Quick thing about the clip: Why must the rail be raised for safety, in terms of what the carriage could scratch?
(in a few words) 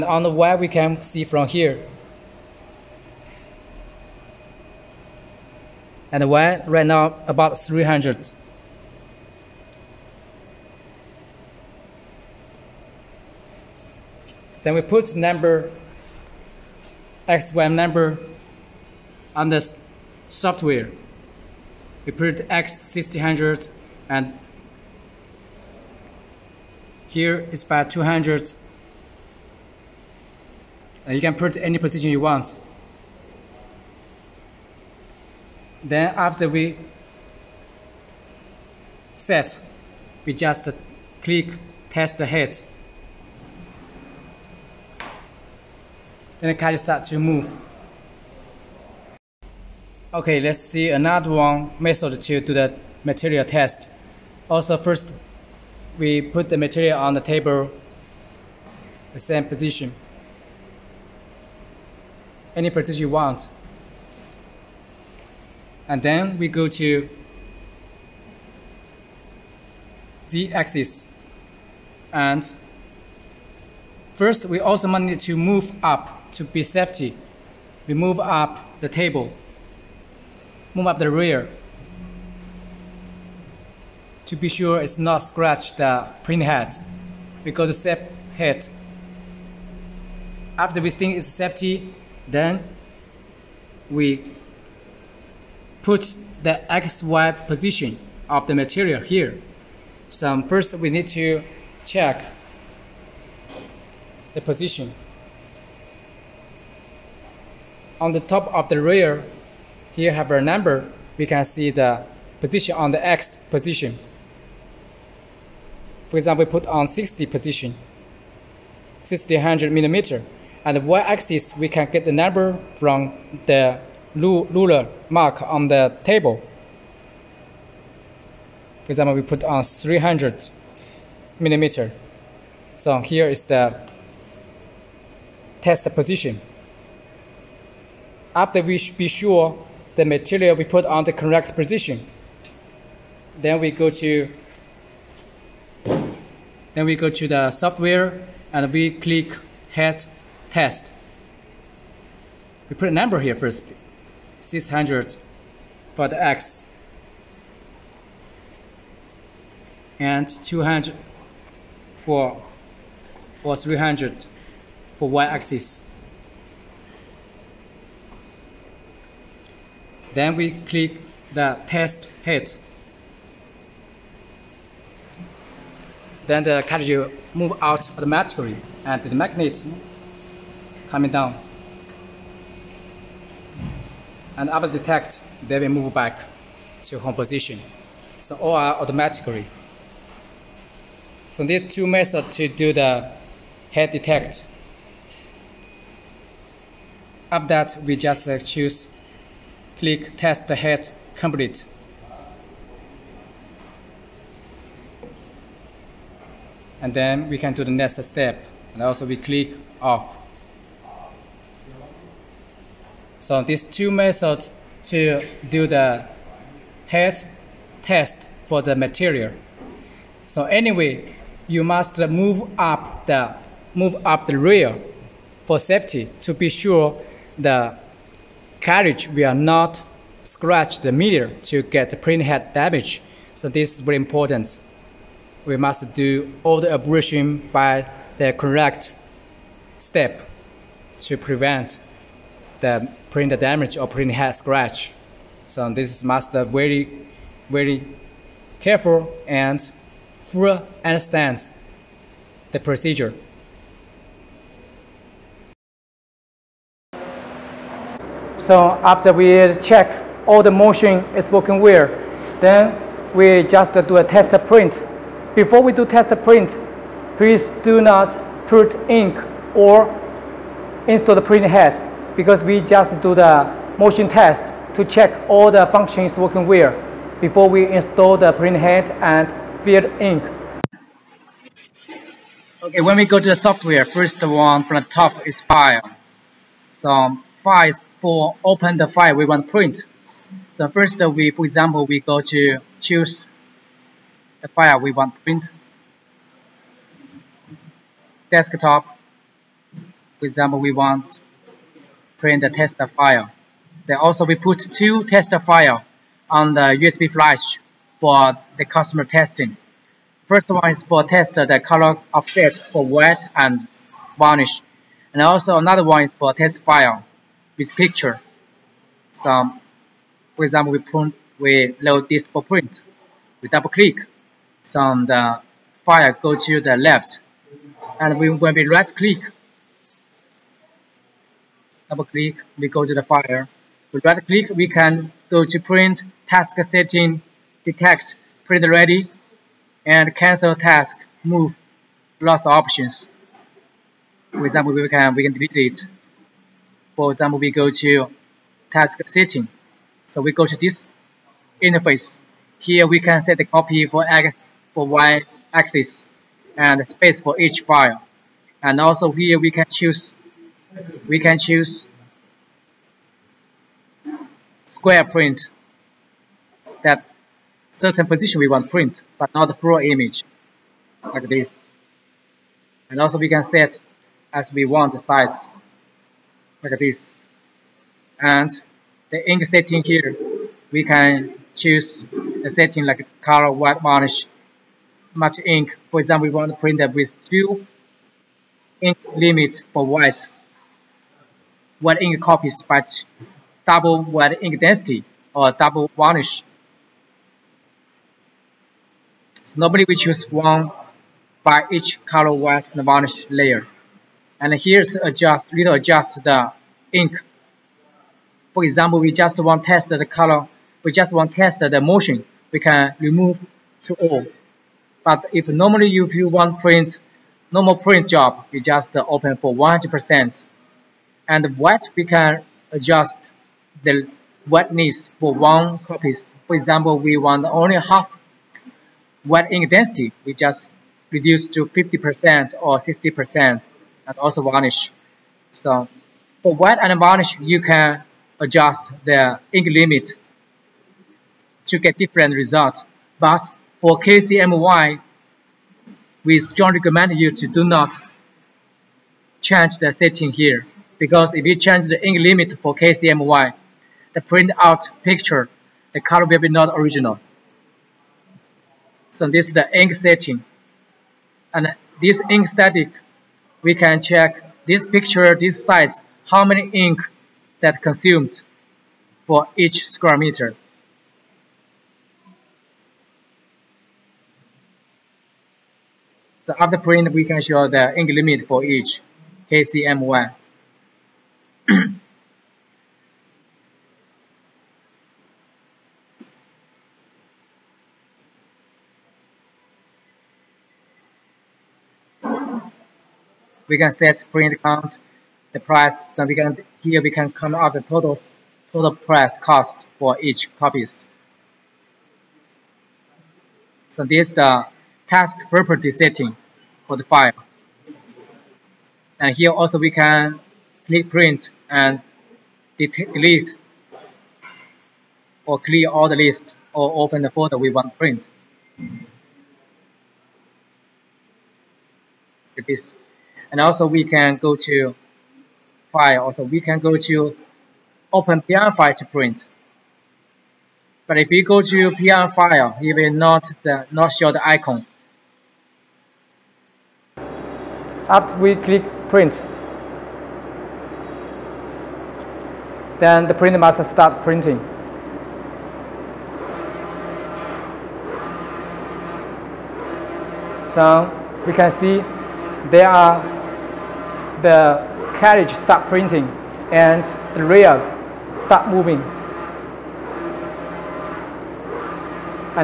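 the mirror.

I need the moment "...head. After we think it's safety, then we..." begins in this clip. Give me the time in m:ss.
1:28.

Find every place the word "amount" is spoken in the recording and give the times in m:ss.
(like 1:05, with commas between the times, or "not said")
not said.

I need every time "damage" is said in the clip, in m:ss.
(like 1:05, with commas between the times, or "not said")
3:52, 4:03.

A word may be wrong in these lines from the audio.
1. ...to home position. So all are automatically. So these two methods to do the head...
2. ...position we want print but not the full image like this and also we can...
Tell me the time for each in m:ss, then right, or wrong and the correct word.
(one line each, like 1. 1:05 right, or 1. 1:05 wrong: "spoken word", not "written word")
1. 3:06 right
2. 6:08 right.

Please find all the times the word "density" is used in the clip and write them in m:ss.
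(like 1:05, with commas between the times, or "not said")
6:34, 7:09.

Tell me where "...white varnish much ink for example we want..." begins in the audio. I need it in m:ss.
6:23.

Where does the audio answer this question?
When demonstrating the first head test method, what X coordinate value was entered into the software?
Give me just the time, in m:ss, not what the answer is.
0:22.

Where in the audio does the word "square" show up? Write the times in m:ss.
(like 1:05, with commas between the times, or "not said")
6:04, 7:49.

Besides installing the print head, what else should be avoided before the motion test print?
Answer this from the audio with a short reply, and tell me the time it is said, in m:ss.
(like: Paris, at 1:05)
put ink, at 4:27.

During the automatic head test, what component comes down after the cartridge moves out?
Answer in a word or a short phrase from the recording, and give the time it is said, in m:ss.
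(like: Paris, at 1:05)
the magnet, at 2:59.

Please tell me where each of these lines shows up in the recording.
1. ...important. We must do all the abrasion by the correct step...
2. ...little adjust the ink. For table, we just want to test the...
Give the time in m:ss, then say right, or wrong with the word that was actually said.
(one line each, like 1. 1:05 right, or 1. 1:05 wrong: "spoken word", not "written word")
1. 3:53 right
2. 6:45 wrong: "example", not "table".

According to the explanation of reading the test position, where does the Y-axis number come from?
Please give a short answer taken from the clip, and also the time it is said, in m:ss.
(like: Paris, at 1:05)
ruler mark on the table, at 2:04.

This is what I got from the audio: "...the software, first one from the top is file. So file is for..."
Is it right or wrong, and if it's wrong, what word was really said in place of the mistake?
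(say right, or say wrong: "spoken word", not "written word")
right.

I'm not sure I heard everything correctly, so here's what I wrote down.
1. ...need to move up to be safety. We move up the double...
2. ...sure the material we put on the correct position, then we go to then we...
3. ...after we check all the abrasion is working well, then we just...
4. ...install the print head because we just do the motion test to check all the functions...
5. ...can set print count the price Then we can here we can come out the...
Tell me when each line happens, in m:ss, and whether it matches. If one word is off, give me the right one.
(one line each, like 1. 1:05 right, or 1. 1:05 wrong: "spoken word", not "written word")
1. 1:14 wrong: "table", not "double"
2. 2:19 right
3. 4:18 wrong: "motion", not "abrasion"
4. 4:30 right
5. 8:13 right.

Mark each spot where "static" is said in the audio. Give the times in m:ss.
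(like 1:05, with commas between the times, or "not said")
7:42.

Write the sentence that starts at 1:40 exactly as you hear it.
So um, first we need to check the position.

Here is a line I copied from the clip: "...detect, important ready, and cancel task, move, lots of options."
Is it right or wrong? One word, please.
wrong.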